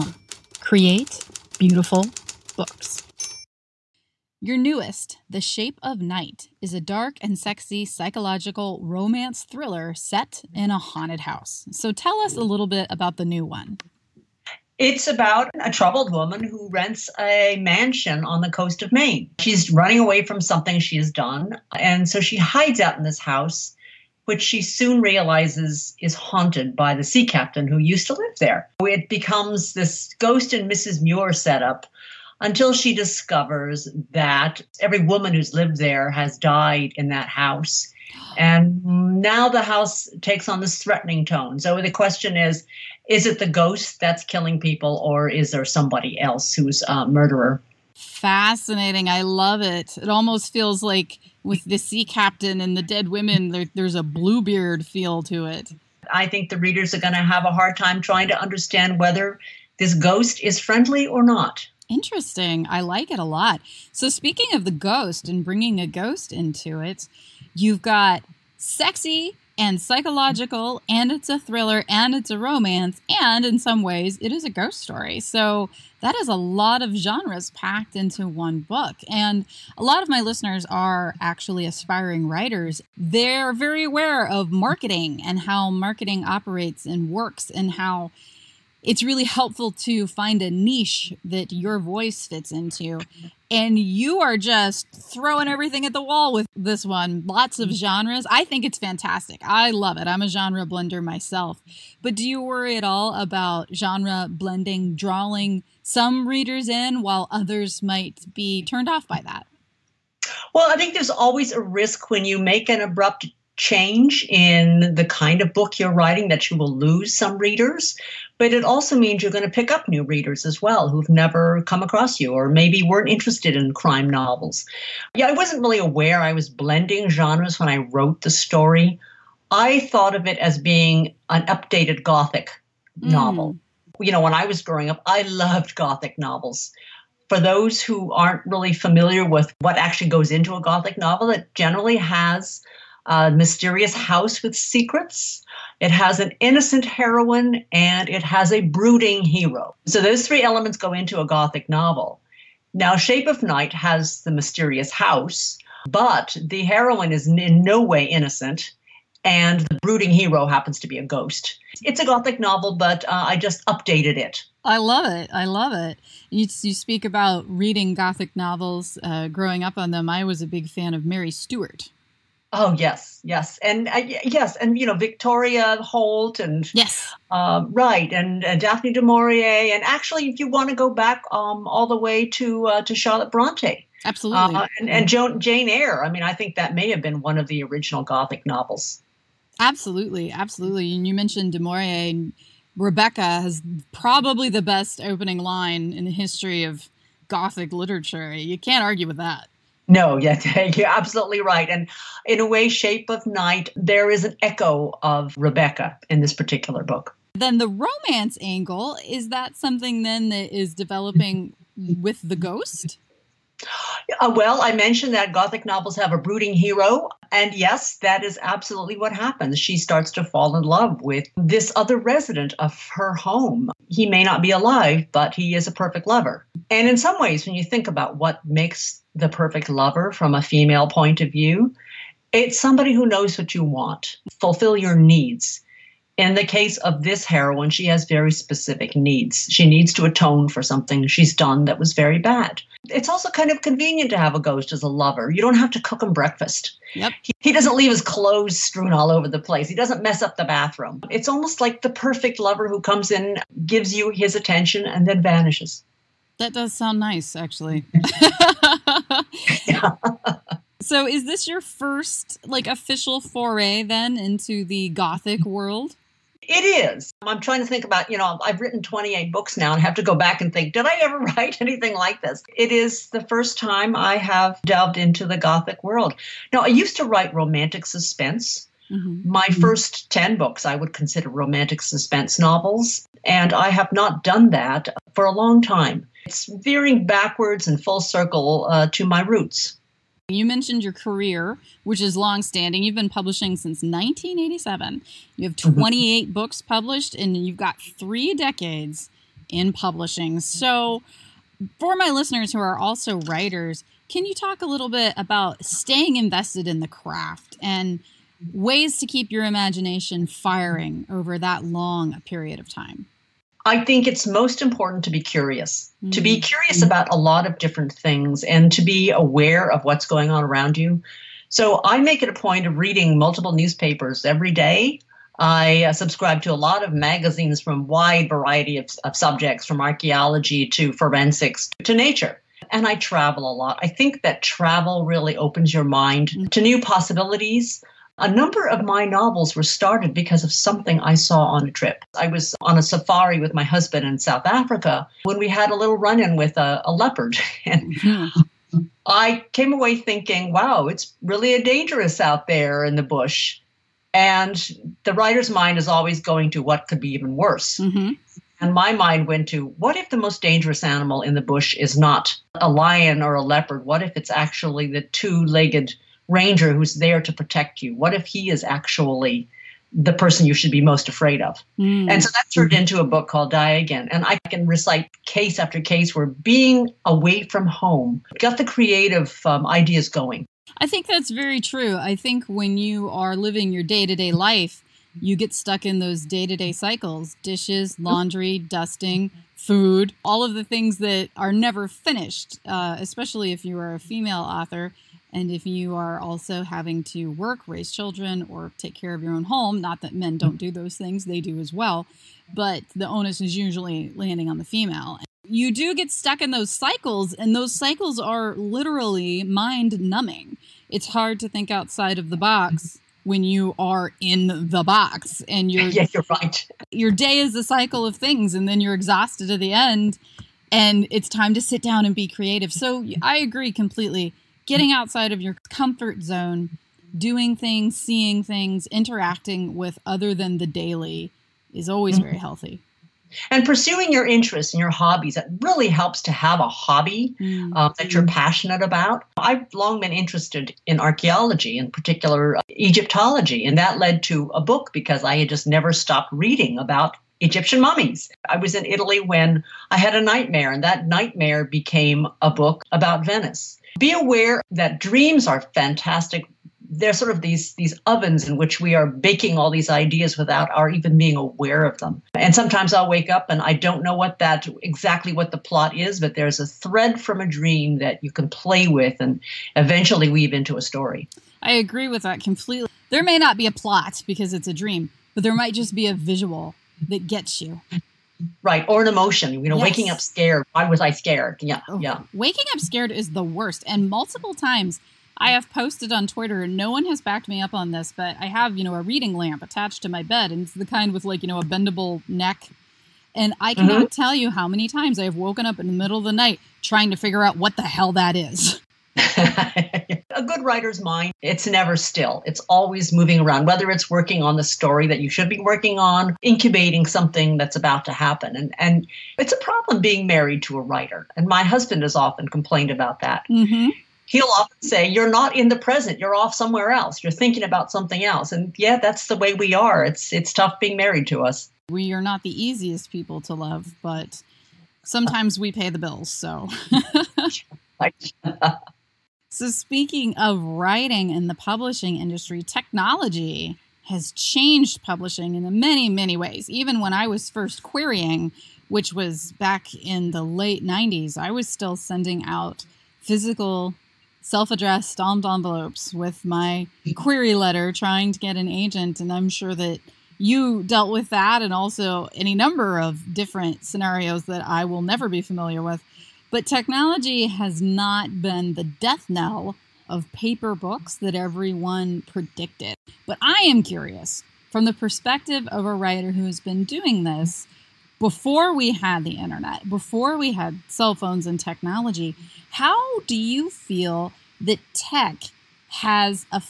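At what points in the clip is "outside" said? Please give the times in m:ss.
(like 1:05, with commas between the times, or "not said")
6:51, 7:04.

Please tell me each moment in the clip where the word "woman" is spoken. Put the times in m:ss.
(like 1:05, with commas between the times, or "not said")
0:16, 0:35.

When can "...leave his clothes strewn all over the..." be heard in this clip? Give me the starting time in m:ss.
4:07.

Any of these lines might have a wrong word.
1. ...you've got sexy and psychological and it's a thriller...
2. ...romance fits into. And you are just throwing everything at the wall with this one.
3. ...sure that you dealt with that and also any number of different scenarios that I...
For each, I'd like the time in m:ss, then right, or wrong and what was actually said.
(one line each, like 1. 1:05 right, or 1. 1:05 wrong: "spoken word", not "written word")
1. 1:07 right
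2. 1:31 wrong: "voice", not "romance"
3. 9:09 right.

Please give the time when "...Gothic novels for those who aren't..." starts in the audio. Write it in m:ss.
2:15.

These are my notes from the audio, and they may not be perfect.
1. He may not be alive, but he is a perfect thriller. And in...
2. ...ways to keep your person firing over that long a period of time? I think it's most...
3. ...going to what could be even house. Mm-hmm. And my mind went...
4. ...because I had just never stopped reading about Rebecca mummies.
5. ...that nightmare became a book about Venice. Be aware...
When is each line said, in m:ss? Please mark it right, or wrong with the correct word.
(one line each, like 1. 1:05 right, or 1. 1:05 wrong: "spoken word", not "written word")
1. 3:43 wrong: "lover", not "thriller"
2. 5:08 wrong: "imagination", not "person"
3. 5:56 wrong: "worse", not "house"
4. 7:24 wrong: "Egyptian", not "Rebecca"
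5. 7:30 right.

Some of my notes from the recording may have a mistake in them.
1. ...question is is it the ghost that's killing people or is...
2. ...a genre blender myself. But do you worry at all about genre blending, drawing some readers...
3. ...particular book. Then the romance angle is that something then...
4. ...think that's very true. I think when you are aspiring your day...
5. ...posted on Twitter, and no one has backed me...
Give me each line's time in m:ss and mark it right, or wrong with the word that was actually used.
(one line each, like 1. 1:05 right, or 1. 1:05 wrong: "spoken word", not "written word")
1. 0:41 right
2. 1:40 right
3. 3:26 right
4. 6:20 wrong: "living", not "aspiring"
5. 8:05 right.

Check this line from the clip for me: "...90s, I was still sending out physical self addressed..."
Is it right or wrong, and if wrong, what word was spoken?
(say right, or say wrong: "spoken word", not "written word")
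right.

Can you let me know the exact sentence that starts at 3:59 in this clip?
She needs to atone for something she's done that was very bad.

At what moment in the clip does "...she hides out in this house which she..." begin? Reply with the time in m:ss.
0:22.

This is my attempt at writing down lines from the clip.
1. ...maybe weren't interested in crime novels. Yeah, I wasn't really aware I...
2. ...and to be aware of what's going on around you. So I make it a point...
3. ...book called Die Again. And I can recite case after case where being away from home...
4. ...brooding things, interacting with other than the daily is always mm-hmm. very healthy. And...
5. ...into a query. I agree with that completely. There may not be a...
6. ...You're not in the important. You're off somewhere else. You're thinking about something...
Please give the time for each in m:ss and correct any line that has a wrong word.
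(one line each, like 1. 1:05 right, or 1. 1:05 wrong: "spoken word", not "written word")
1. 2:02 right
2. 5:18 right
3. 6:13 right
4. 7:07 wrong: "seeing", not "brooding"
5. 7:50 wrong: "story", not "query"
6. 8:35 wrong: "present", not "important".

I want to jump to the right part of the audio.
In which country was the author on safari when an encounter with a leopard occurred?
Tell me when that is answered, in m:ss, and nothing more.
5:44.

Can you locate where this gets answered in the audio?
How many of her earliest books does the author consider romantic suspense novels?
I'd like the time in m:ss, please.
4:39.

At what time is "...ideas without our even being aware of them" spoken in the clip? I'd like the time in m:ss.
7:39.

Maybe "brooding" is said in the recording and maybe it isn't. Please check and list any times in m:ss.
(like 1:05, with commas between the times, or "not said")
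2:28, 2:39, 3:36.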